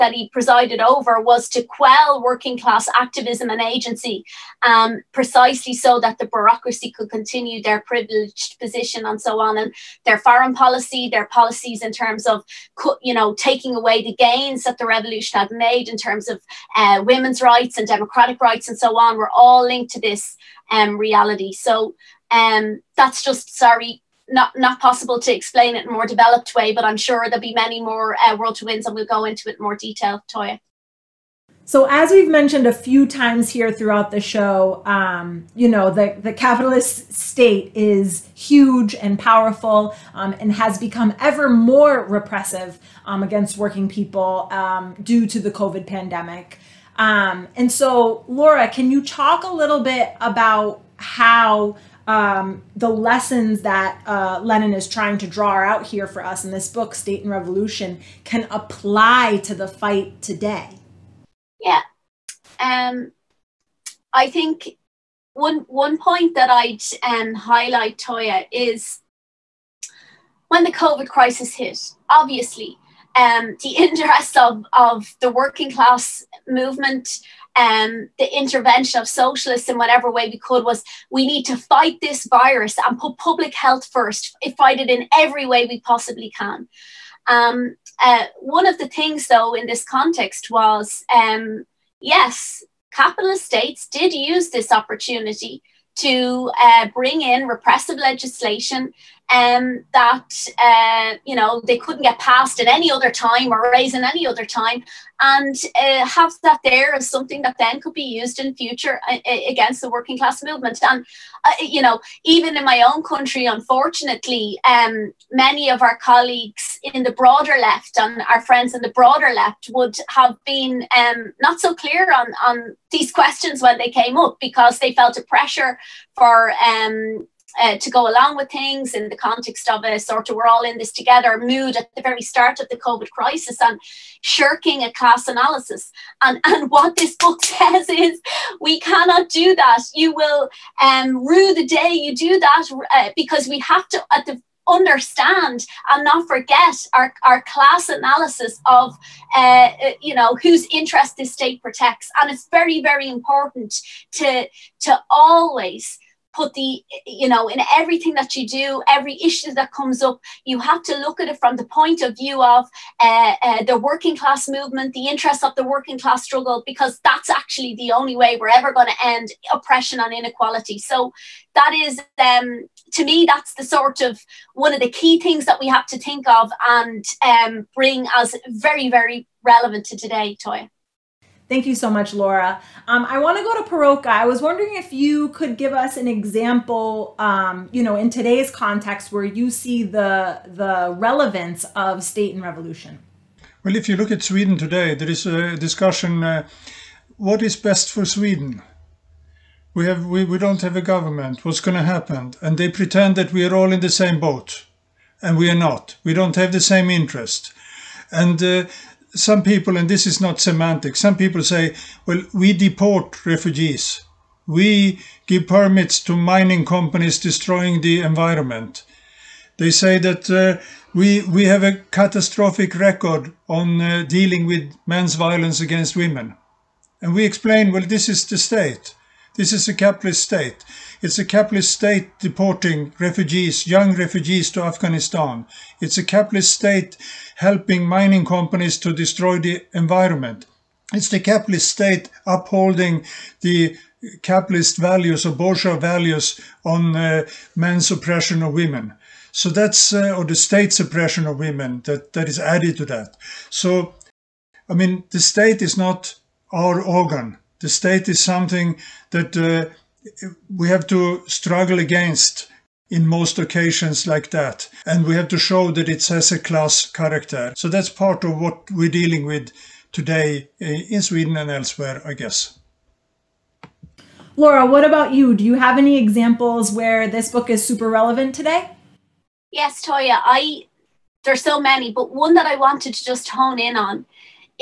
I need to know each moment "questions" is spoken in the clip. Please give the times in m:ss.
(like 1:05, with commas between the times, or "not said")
2:03.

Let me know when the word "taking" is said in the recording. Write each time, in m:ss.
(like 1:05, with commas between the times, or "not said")
0:13.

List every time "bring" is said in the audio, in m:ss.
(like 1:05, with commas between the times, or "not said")
1:36, 2:57.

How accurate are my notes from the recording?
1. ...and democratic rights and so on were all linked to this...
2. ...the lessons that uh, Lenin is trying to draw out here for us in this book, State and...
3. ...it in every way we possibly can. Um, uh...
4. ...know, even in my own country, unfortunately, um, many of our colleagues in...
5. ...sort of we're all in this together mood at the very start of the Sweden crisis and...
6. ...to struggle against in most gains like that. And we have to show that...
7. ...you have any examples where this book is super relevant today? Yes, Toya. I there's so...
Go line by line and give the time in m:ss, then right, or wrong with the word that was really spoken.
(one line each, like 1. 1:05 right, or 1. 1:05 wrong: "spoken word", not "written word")
1. 0:17 right
2. 0:52 right
3. 1:24 right
4. 1:51 right
5. 2:09 wrong: "COVID", not "Sweden"
6. 4:20 wrong: "occasions", not "gains"
7. 4:35 right.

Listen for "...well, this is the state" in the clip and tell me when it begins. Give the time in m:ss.
3:47.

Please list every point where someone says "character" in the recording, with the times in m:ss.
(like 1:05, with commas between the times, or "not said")
4:26.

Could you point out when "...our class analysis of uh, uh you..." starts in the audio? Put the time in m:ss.
2:27.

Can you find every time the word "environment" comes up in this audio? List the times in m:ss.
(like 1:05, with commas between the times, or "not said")
3:38, 3:59.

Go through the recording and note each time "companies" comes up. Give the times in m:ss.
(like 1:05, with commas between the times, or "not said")
3:36, 3:58.